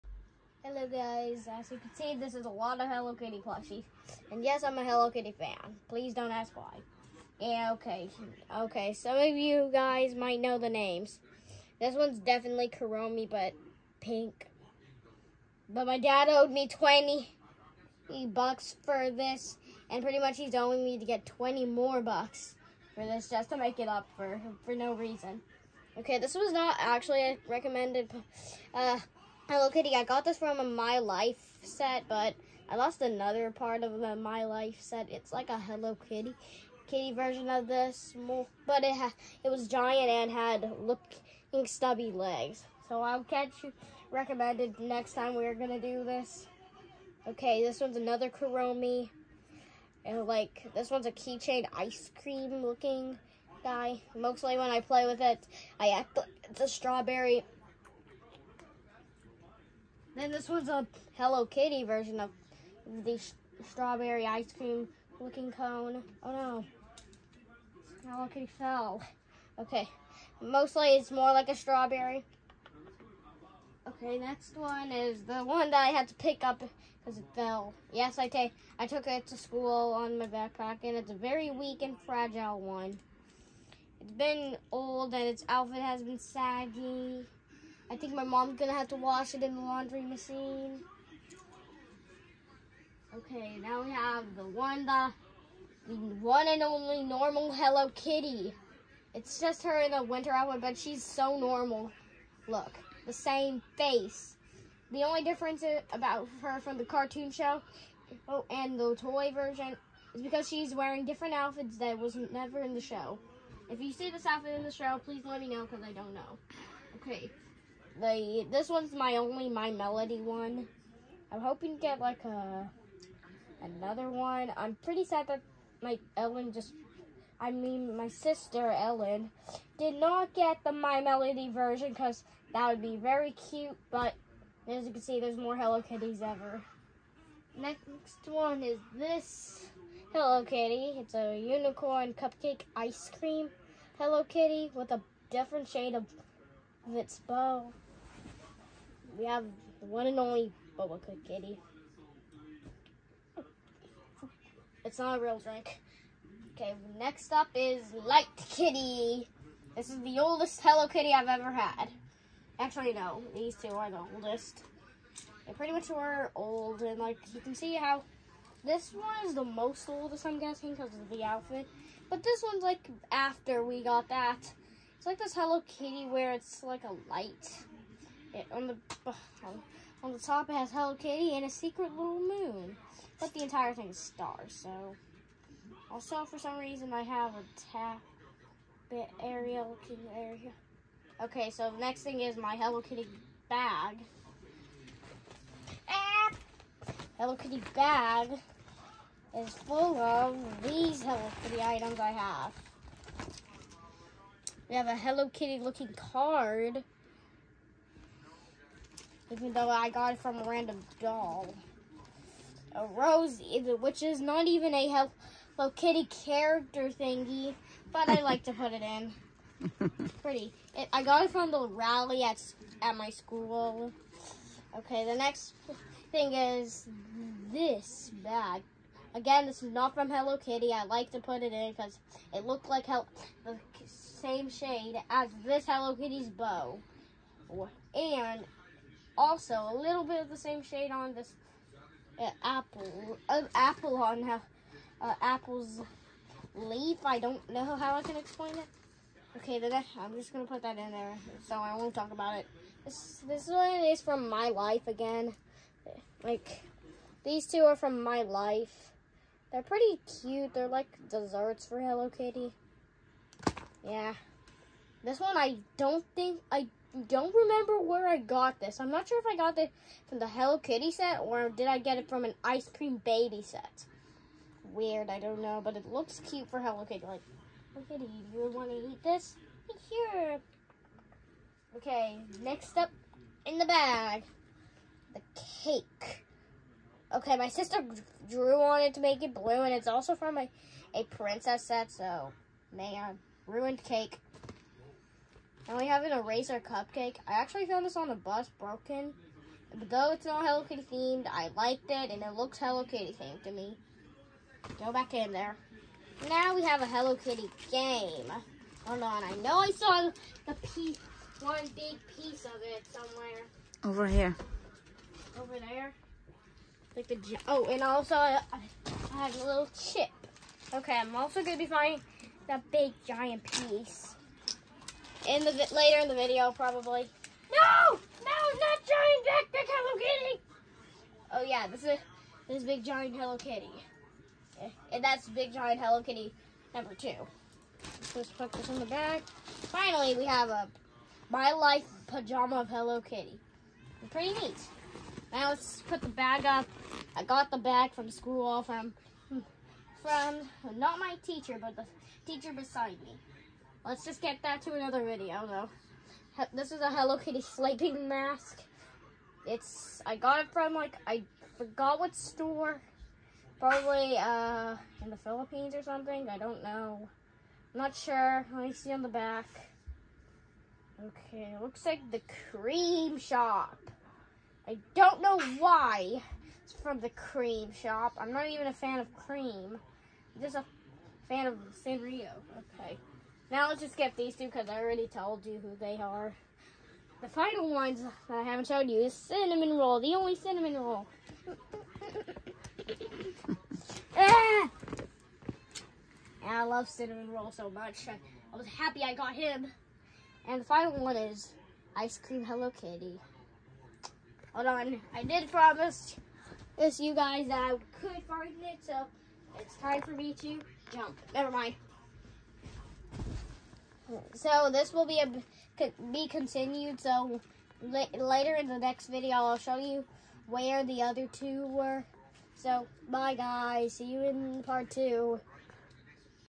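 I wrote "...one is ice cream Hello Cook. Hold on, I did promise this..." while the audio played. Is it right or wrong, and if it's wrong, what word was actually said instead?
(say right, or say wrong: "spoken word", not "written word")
wrong: "Kitty", not "Cook".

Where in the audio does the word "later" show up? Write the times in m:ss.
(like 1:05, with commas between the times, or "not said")
5:25, 6:57.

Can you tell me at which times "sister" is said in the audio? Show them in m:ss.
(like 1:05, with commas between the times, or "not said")
2:08, 4:47.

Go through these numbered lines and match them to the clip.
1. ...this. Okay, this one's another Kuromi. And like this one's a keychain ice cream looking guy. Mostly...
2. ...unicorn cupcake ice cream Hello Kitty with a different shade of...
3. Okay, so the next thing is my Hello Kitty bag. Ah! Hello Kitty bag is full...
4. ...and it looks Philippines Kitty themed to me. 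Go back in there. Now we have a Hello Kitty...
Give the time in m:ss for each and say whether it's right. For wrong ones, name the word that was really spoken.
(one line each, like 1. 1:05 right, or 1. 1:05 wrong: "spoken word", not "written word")
1. 0:46 right
2. 2:21 right
3. 3:11 right
4. 5:02 wrong: "Hello", not "Philippines".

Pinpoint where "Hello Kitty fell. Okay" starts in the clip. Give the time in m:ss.
1:08.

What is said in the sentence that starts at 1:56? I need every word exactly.
Okay, the this one's my only my melody one.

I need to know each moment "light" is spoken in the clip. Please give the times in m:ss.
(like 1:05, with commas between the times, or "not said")
2:38, 2:57.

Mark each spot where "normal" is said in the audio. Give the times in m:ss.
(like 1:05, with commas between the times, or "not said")
1:37, 1:41.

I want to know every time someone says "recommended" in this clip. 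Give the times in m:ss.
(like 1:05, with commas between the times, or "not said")
0:27, 0:44.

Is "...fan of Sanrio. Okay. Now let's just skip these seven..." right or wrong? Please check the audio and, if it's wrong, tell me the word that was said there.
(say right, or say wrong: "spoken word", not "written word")
wrong: "two", not "seven".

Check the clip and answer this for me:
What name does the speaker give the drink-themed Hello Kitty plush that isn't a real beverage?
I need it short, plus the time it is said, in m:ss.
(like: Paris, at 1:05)
Boba Cook Kitty, at 2:30.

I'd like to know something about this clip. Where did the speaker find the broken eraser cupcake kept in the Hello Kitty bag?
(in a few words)
On the bus.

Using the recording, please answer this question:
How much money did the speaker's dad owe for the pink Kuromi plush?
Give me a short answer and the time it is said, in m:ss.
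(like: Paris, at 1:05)
$20, at 0:16.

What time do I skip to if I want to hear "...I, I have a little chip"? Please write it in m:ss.
5:18.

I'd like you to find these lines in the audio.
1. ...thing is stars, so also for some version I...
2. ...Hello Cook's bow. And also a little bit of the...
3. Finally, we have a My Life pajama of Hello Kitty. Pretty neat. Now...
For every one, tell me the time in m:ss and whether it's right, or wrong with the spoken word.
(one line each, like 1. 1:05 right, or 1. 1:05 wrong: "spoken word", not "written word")
1. 3:03 wrong: "reason", not "version"
2. 3:55 wrong: "Kitty", not "Cook"
3. 5:39 right.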